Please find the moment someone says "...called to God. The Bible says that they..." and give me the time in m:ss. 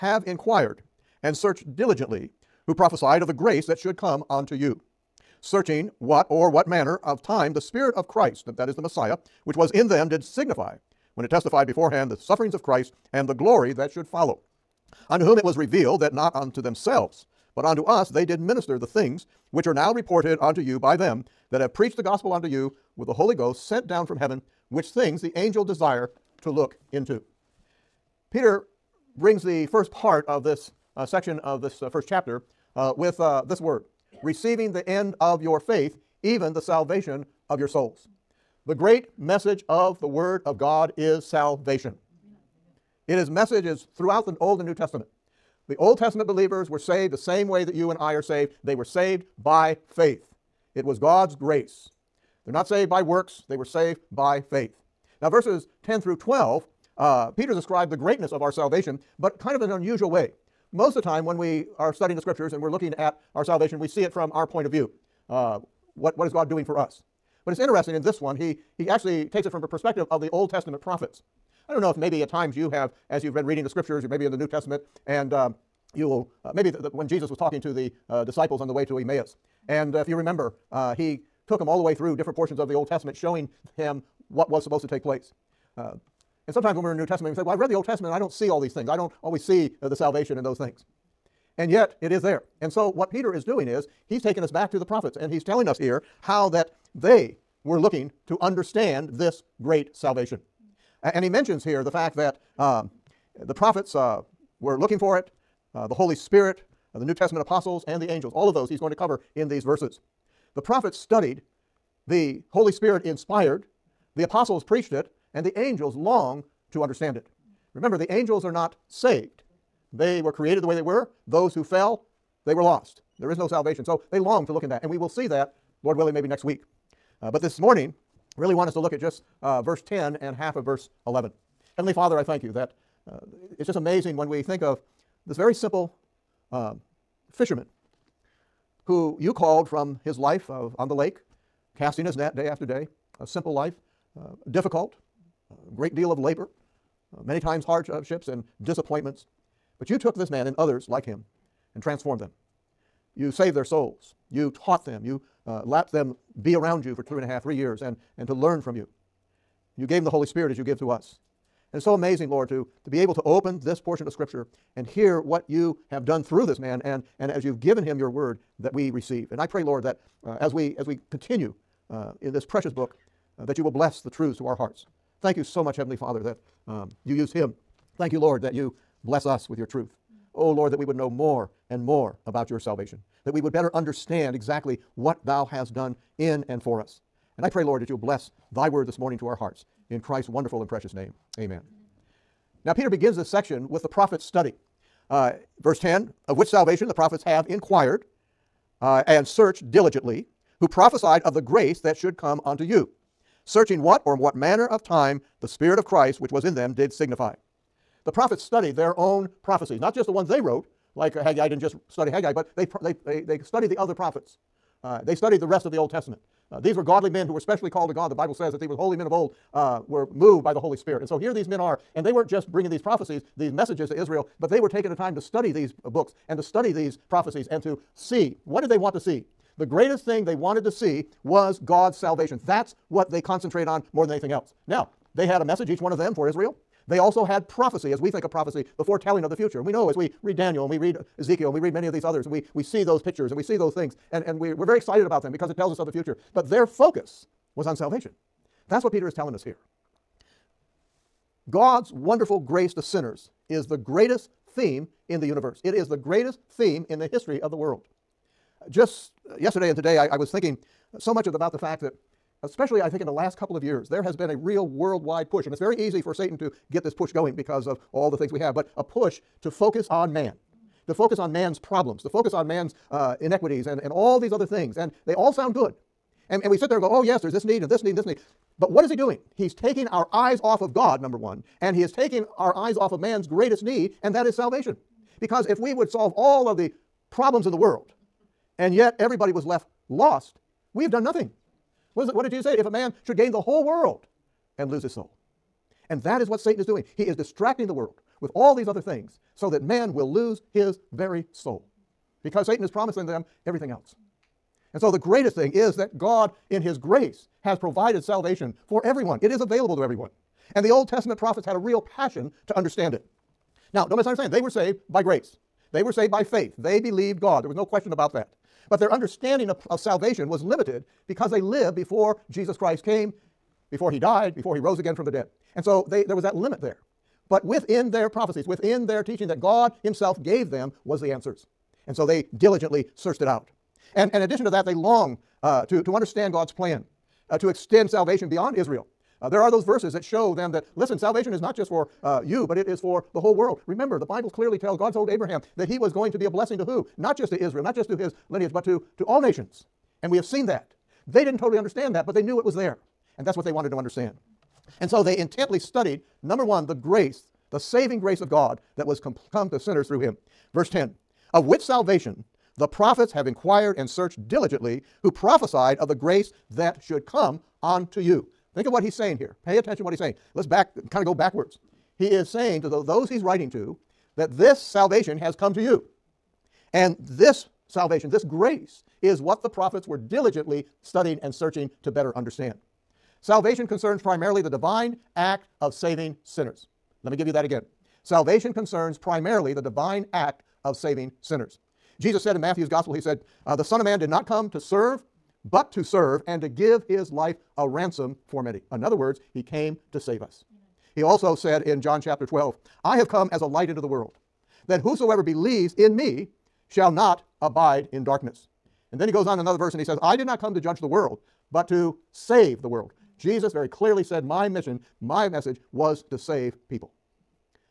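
3:37.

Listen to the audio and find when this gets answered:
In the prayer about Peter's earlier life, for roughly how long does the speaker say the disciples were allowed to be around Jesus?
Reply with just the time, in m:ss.
2:37.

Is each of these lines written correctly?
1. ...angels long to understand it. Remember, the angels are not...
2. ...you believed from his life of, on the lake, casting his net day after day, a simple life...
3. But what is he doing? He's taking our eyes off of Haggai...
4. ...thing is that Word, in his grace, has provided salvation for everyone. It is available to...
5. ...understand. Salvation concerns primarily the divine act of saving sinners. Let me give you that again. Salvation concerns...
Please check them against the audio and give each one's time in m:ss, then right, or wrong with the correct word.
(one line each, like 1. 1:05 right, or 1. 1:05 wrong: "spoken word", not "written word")
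1. 1:55 right
2. 2:19 wrong: "called", not "believed"
3. 4:38 wrong: "God", not "Haggai"
4. 5:05 wrong: "God", not "Word"
5. 6:22 right.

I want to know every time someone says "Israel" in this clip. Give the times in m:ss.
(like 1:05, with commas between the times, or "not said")
3:43, 3:56, 5:38, 5:47.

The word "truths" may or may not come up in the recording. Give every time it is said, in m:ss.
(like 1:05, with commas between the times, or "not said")
2:54, 2:59.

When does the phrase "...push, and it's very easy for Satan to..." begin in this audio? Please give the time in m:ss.
4:25.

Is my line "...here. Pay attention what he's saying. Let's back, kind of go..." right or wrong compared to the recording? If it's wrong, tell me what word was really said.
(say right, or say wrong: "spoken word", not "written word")
right.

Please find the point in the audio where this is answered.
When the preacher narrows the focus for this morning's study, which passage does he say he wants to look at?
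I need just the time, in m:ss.
2:09.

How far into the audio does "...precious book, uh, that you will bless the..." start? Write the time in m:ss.
2:52.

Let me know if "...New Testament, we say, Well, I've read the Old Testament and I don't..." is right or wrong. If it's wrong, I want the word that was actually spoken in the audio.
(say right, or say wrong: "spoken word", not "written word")
right.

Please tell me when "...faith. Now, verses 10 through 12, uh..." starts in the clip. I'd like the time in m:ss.
0:54.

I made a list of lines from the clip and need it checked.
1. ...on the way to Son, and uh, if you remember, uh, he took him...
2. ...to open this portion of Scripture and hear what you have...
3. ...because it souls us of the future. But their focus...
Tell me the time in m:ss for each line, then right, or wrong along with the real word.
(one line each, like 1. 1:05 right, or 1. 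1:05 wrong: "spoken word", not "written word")
1. 1:18 wrong: "Emmaus", not "Son"
2. 2:43 right
3. 4:05 wrong: "tells", not "souls".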